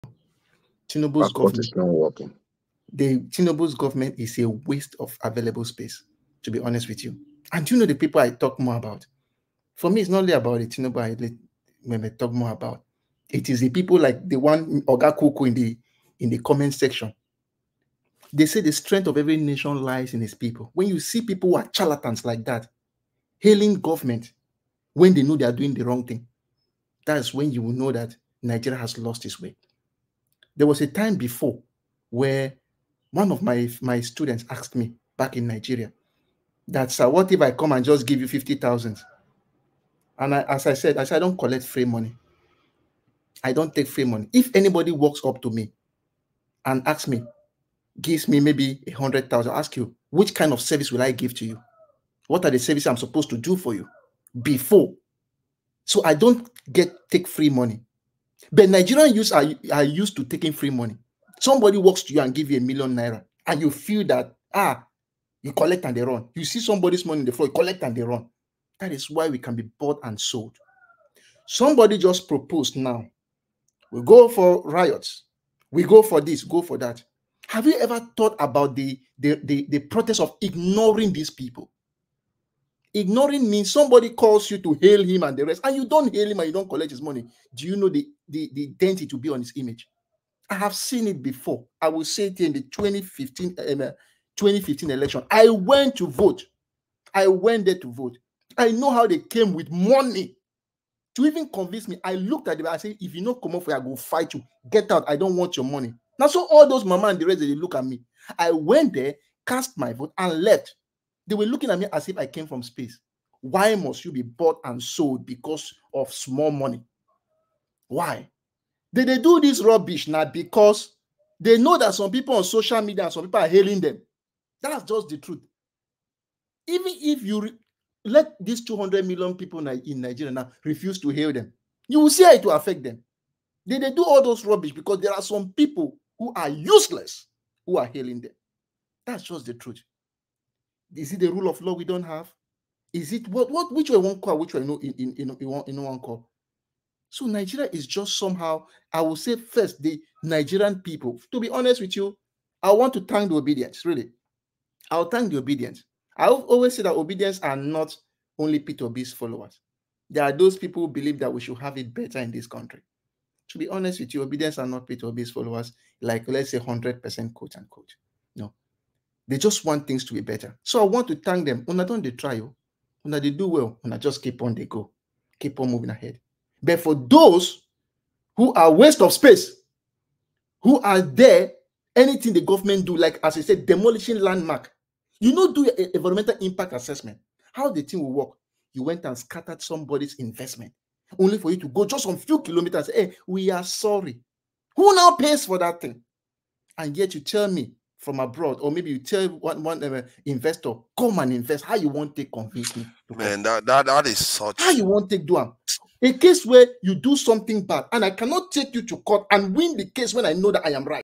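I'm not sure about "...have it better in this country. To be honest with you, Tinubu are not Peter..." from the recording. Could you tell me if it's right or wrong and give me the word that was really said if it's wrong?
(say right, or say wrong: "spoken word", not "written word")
wrong: "Obidients", not "Tinubu".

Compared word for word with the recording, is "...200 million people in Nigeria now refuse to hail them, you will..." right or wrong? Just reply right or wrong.
right.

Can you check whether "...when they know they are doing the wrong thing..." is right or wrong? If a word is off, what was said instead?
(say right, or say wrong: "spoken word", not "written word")
right.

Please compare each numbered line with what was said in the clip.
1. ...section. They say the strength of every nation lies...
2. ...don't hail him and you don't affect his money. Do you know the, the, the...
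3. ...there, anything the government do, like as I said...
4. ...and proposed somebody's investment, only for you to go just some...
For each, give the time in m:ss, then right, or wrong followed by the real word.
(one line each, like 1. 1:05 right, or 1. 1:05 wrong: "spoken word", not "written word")
1. 0:16 right
2. 1:25 wrong: "collect", not "affect"
3. 3:01 right
4. 3:09 wrong: "scattered", not "proposed".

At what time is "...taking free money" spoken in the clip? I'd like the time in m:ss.
1:00.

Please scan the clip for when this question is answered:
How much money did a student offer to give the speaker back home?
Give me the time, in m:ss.
0:38.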